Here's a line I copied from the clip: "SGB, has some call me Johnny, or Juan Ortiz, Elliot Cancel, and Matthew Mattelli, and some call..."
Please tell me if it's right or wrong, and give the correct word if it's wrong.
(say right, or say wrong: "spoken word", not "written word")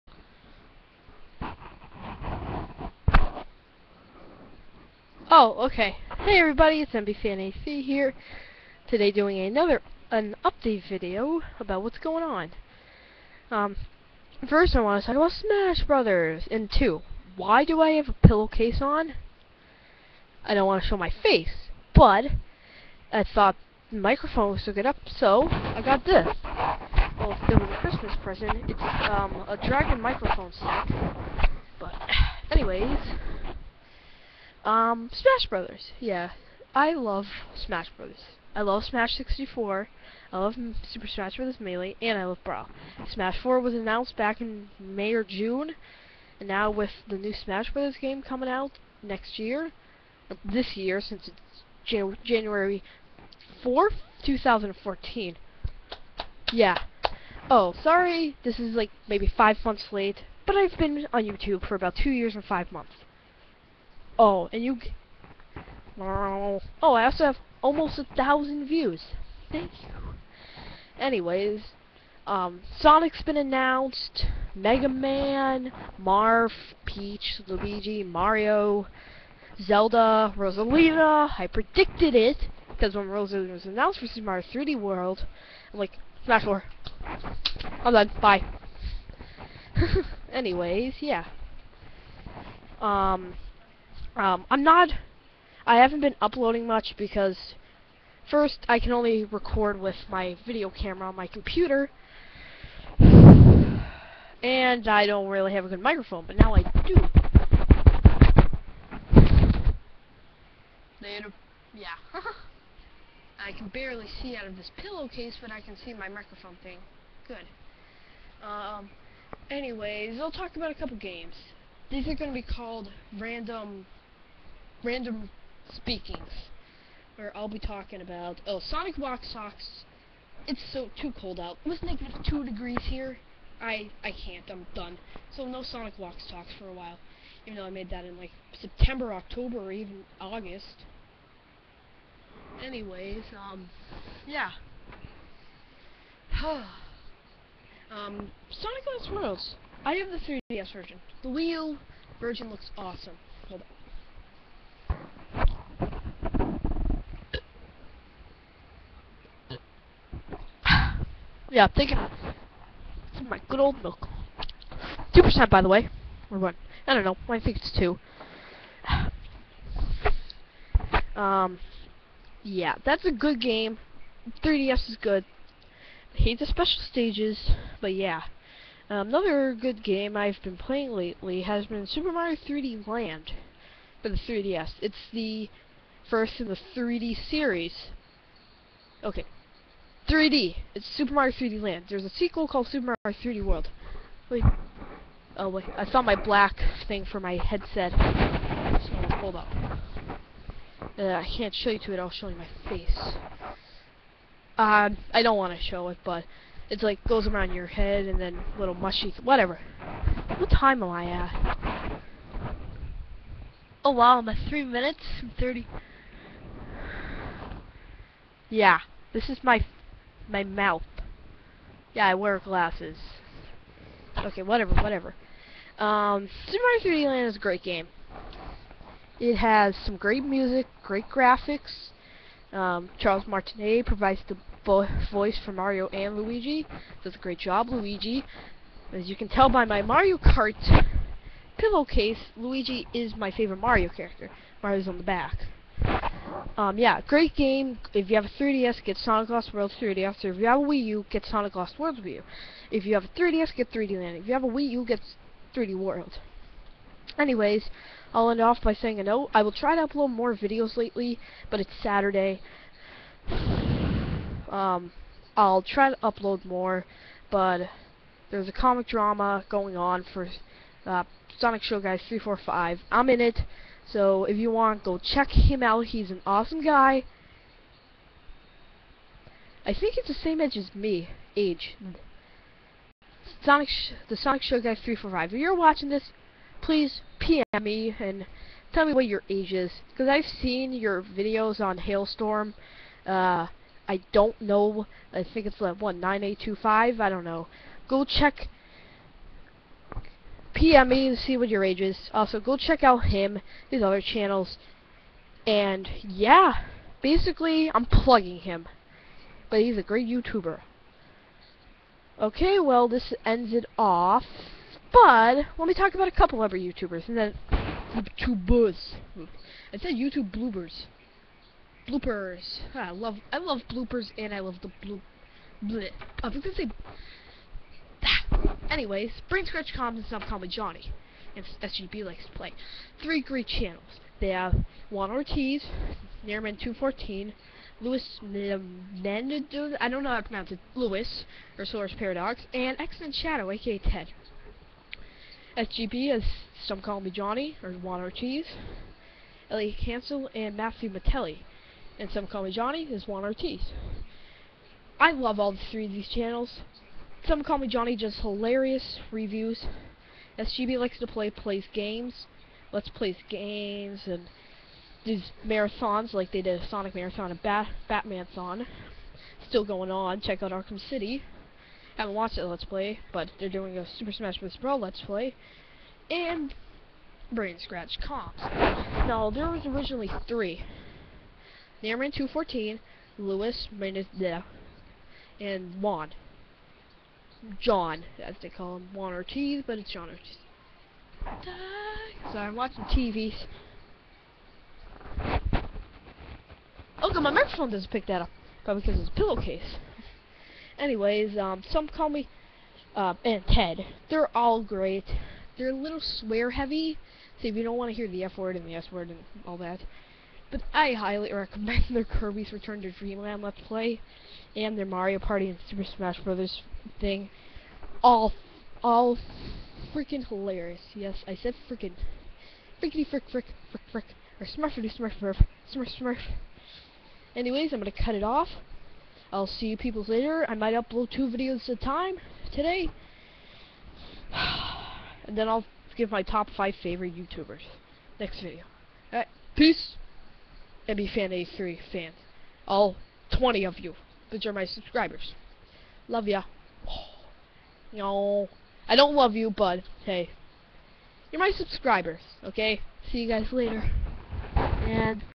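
right.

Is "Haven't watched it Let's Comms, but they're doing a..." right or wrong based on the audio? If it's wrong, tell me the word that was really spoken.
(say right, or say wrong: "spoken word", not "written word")
wrong: "Play", not "Comms".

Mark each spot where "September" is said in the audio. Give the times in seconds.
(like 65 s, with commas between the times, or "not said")
138 s.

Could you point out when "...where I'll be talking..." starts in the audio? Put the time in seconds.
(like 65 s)
127 s.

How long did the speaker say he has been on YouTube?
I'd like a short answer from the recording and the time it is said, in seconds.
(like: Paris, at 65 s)
2 years and 5 months, at 61 s.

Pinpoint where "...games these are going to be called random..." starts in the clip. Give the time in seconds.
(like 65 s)
120 s.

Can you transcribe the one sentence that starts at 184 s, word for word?
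It's the first in the 3D series.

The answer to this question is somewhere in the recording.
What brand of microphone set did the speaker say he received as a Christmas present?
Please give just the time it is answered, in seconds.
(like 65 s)
29 s.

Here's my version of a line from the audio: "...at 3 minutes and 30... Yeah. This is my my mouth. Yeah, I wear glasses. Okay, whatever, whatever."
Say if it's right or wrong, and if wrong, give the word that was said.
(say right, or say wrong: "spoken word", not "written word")
right.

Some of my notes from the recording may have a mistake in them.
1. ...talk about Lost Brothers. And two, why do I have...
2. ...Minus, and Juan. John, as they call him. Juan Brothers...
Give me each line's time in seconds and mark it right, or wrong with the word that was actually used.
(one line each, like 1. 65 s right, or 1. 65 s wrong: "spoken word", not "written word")
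1. 15 s wrong: "Smash", not "Lost"
2. 383 s wrong: "Ortiz", not "Brothers".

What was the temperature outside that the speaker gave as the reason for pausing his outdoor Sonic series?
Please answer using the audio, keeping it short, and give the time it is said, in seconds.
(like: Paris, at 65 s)
-2 degrees, at 131 s.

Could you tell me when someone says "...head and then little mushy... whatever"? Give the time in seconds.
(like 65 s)
207 s.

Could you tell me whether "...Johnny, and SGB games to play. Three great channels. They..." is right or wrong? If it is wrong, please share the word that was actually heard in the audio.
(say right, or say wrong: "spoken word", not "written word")
wrong: "likes", not "games".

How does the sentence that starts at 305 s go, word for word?
And, yeah, basically, I'm plugging him.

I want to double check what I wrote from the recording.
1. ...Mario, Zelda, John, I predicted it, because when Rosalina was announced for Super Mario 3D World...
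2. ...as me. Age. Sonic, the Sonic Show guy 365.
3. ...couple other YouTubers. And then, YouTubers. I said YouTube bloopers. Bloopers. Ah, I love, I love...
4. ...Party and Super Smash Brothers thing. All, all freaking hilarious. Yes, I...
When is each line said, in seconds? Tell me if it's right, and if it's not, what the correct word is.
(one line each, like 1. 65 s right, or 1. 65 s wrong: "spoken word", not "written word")
1. 78 s wrong: "Rosalina", not "John"
2. 280 s wrong: "345", not "365"
3. 316 s right
4. 415 s right.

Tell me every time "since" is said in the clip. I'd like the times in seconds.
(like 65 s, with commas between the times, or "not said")
51 s.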